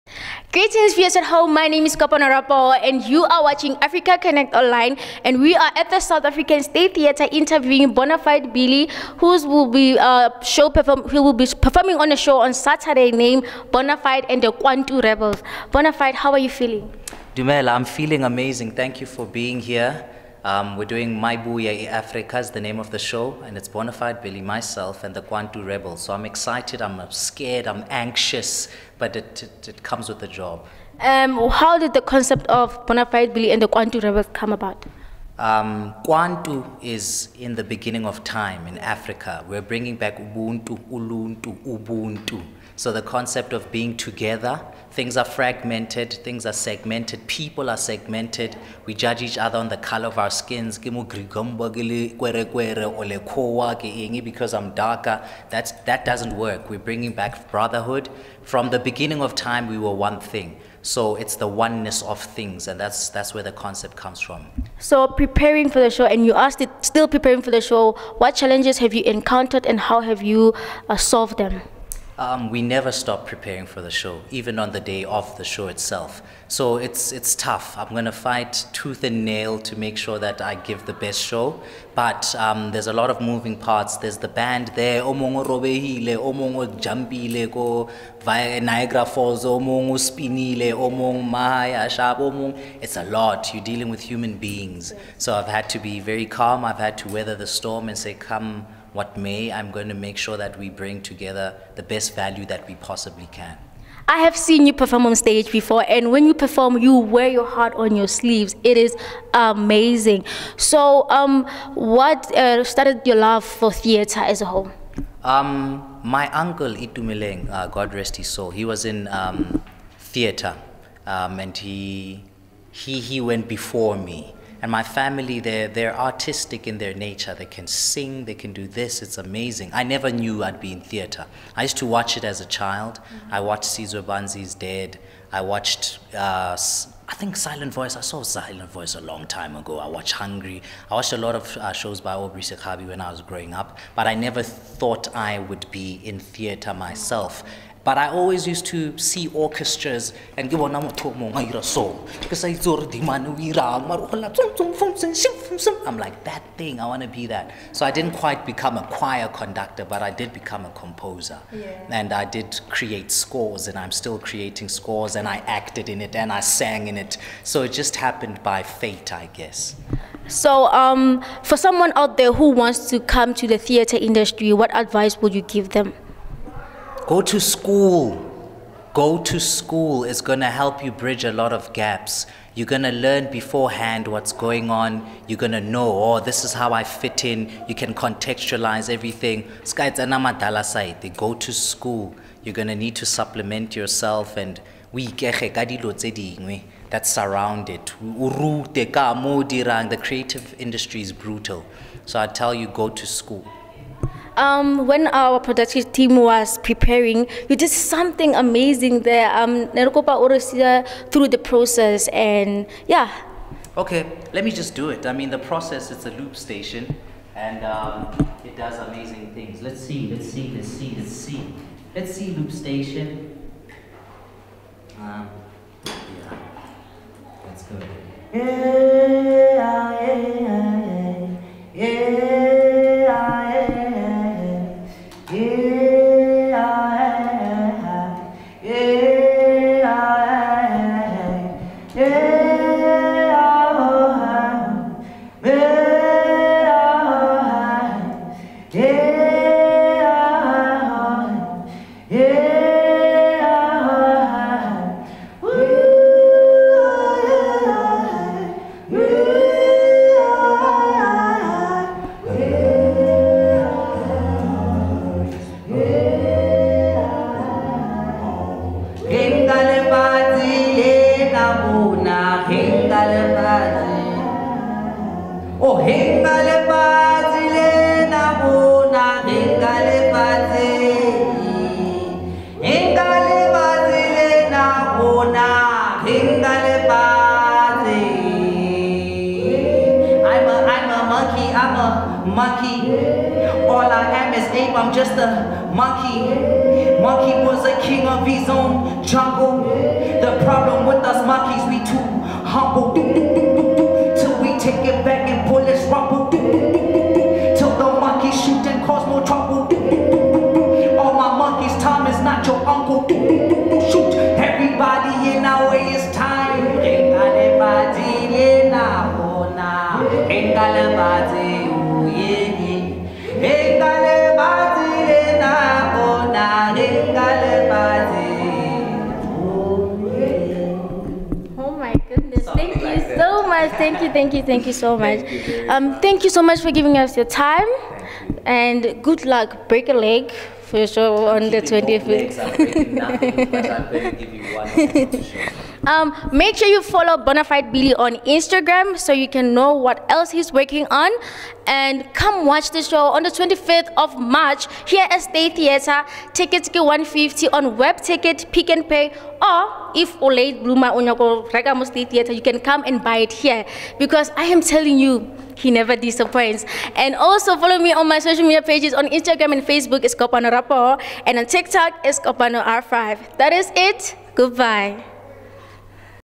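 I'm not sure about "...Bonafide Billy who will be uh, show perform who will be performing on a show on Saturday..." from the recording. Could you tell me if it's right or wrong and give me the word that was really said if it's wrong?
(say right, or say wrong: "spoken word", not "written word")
right.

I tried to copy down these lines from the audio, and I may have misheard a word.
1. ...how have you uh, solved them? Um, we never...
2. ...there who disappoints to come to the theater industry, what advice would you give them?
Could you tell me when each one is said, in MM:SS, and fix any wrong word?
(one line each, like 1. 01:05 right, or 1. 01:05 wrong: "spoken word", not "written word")
1. 01:09 right
2. 02:52 wrong: "wants", not "disappoints".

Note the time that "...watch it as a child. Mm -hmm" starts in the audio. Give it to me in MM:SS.
02:11.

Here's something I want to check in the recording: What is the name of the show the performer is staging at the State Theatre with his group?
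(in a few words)
Mayibuye Africa.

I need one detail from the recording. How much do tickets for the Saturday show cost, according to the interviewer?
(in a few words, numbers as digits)
150.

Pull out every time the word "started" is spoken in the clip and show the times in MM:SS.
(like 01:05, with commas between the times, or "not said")
01:52.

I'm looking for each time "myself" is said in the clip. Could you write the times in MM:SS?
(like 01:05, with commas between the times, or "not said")
00:24, 02:26.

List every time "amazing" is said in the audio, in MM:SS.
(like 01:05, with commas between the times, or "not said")
00:18, 01:49, 02:09, 03:28, 03:38.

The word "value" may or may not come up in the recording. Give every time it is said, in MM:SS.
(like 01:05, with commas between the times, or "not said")
01:42.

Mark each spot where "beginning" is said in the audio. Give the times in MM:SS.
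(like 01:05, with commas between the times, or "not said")
00:37, 00:58.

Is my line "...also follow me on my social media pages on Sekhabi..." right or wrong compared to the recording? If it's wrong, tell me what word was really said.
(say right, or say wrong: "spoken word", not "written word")
wrong: "Instagram", not "Sekhabi".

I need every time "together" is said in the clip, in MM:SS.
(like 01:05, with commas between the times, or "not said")
00:43, 01:41.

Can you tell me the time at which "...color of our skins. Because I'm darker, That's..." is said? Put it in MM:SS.
00:49.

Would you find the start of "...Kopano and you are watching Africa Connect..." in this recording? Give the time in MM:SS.
00:01.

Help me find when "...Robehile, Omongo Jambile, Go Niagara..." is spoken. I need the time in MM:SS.
01:25.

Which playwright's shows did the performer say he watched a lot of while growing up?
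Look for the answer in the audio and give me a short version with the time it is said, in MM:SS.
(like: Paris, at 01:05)
Aubrey Sekhabi, at 02:22.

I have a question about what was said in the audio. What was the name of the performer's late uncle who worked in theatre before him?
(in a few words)
Itumileng.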